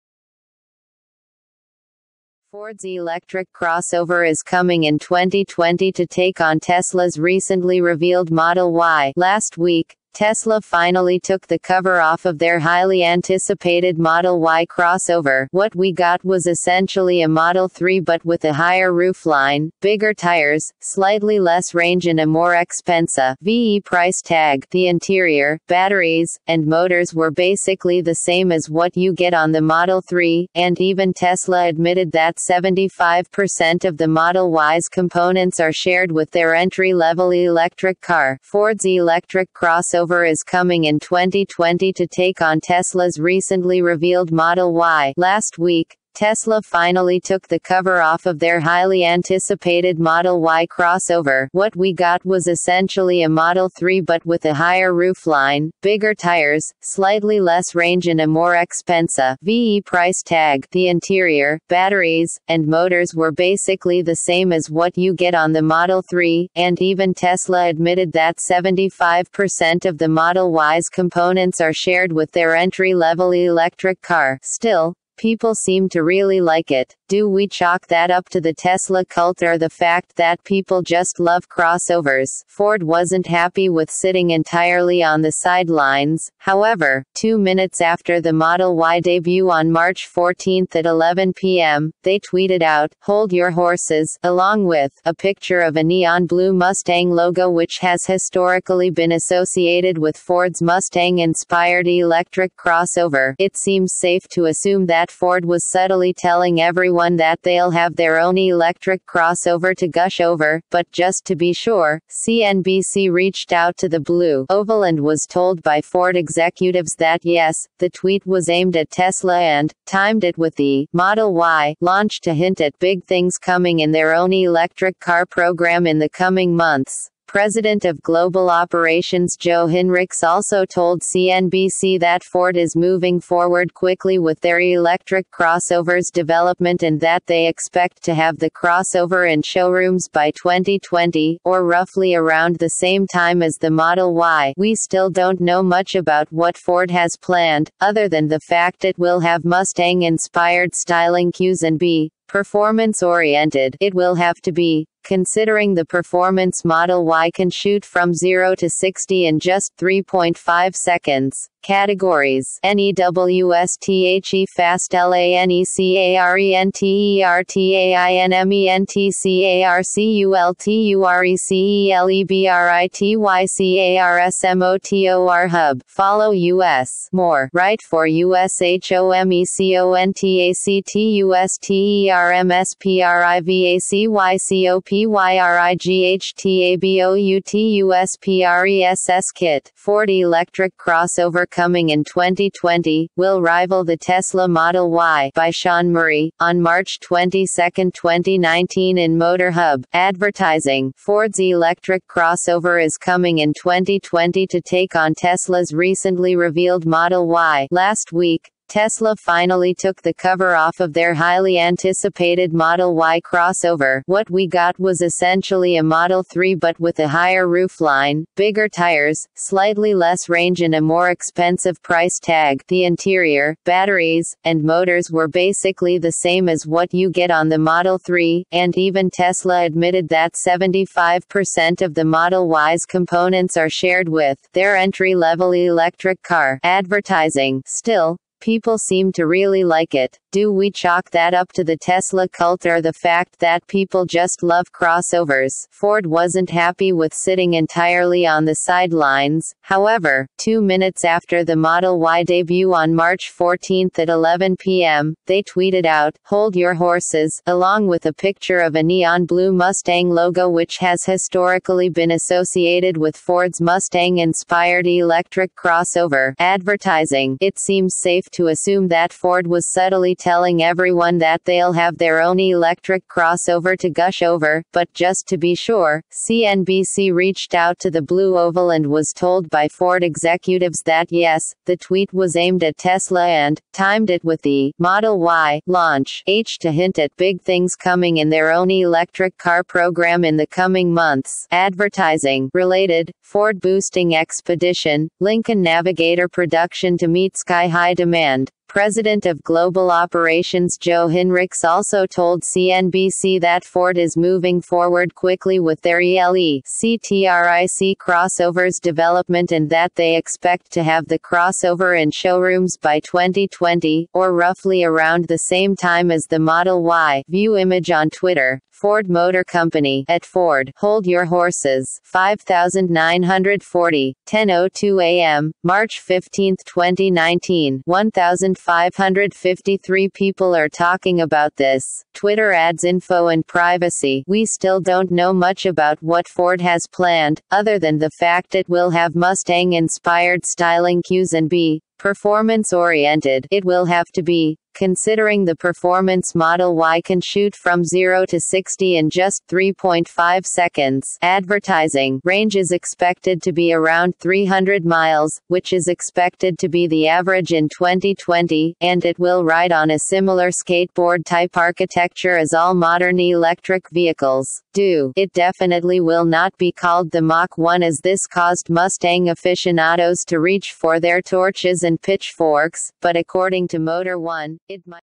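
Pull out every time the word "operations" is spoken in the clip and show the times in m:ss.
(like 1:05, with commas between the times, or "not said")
2:08, 4:59.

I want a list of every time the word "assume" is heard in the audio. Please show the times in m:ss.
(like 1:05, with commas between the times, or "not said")
1:44, 4:28.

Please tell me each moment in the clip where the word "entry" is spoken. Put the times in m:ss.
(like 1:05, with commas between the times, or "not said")
0:36, 1:12, 3:54.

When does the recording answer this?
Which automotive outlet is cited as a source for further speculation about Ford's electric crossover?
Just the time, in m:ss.
6:13.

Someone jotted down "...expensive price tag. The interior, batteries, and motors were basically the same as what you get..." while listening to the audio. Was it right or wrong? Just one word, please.
right.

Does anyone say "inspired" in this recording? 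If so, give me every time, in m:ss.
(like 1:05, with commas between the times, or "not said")
1:41, 2:30, 4:24, 5:39.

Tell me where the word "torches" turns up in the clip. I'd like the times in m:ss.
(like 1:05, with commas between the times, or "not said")
6:11.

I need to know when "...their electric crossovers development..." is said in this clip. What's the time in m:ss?
2:14.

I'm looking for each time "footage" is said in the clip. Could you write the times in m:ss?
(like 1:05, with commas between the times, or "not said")
not said.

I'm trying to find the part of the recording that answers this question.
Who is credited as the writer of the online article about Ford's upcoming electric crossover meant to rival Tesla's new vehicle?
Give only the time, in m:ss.
3:15.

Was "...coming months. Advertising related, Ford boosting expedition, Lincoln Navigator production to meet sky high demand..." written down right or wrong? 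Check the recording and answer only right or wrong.
right.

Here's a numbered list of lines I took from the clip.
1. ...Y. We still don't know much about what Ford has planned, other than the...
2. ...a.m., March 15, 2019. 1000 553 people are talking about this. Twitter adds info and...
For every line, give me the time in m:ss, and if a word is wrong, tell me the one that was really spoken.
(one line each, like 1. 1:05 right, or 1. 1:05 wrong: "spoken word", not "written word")
1. 2:24 right
2. 5:25 right.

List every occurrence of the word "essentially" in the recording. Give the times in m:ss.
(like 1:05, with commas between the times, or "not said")
0:16, 0:52, 3:35.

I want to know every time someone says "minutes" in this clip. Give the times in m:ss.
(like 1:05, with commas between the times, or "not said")
1:27, 4:10.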